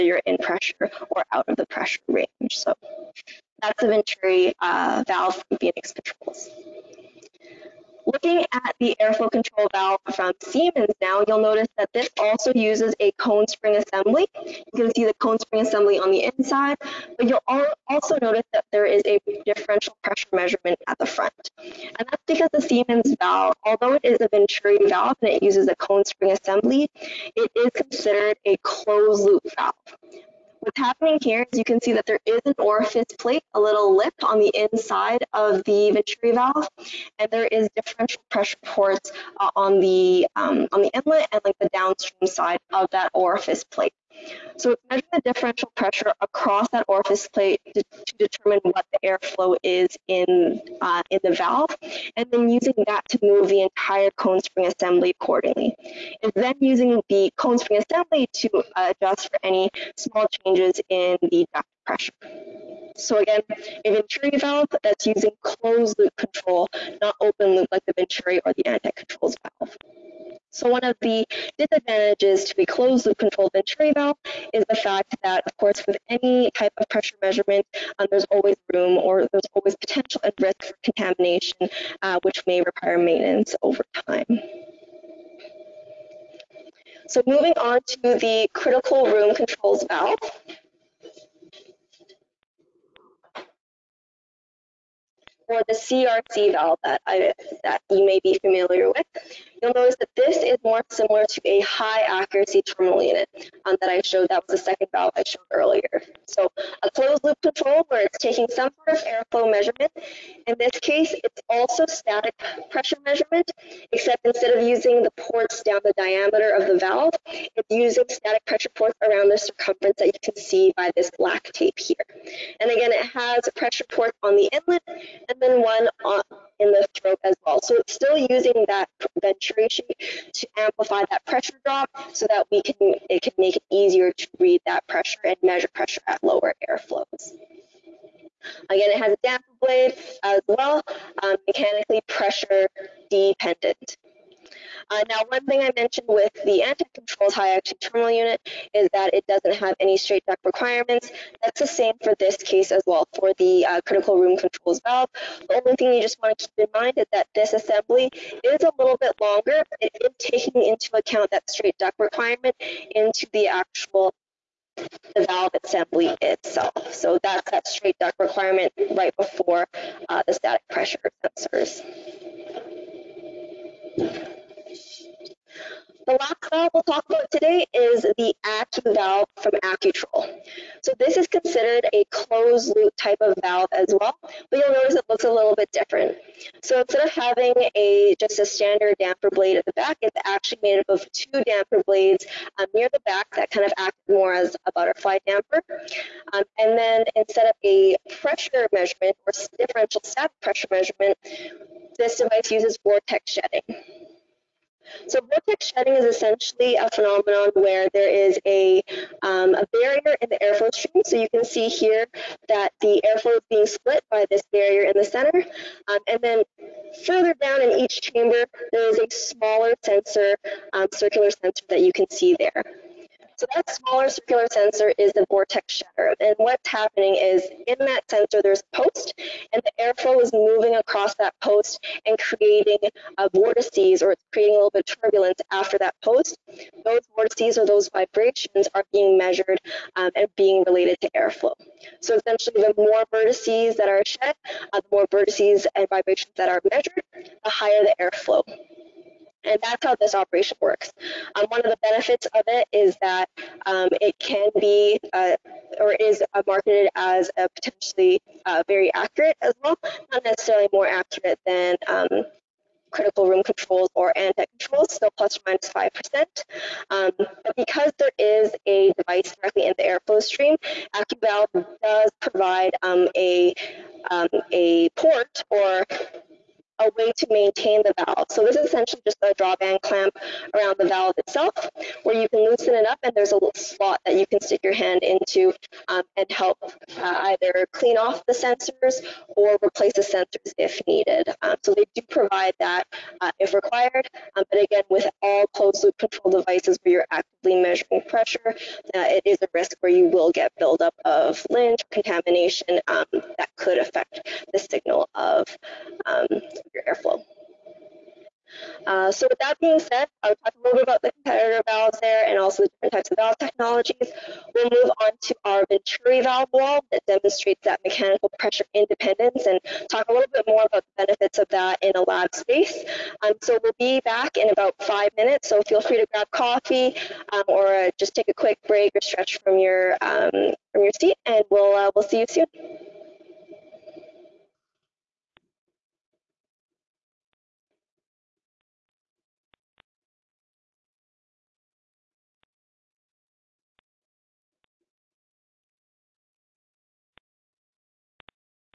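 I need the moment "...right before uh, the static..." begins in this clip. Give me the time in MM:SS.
02:48.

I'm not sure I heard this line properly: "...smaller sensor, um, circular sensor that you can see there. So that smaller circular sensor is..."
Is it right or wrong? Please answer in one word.
right.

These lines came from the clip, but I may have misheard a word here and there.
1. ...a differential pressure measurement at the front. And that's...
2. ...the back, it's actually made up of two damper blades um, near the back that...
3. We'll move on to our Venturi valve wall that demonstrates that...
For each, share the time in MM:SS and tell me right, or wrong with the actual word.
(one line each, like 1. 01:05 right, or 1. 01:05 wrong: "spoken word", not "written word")
1. 00:19 right
2. 03:09 right
3. 05:14 right.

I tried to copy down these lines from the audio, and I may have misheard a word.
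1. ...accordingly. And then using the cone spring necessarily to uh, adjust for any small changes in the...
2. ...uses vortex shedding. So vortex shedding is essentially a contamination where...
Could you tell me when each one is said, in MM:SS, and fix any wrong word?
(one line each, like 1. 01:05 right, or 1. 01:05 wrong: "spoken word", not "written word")
1. 00:55 wrong: "assembly", not "necessarily"
2. 03:22 wrong: "phenomenon", not "contamination".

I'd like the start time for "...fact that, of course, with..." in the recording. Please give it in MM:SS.
01:14.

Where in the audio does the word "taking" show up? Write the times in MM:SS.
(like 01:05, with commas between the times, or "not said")
01:48, 02:40.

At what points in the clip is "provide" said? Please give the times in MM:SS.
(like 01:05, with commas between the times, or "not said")
04:32, 04:52.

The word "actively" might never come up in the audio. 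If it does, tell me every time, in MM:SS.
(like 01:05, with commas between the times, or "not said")
04:57.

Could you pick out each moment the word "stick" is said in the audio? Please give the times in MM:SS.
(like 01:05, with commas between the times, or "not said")
04:44.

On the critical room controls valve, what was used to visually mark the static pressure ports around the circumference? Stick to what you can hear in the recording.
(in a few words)
black tape.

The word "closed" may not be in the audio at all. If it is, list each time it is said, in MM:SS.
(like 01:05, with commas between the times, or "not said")
00:28, 01:05, 01:12, 01:46, 03:02, 04:55.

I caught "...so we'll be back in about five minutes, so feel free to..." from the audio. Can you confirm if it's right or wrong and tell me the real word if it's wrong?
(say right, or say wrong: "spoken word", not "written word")
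right.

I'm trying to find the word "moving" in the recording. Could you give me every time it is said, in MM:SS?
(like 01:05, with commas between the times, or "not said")
01:27, 03:50.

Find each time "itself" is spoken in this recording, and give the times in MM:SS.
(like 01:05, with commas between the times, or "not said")
02:46, 04:41.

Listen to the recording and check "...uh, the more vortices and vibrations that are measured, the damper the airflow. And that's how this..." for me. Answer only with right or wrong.
wrong.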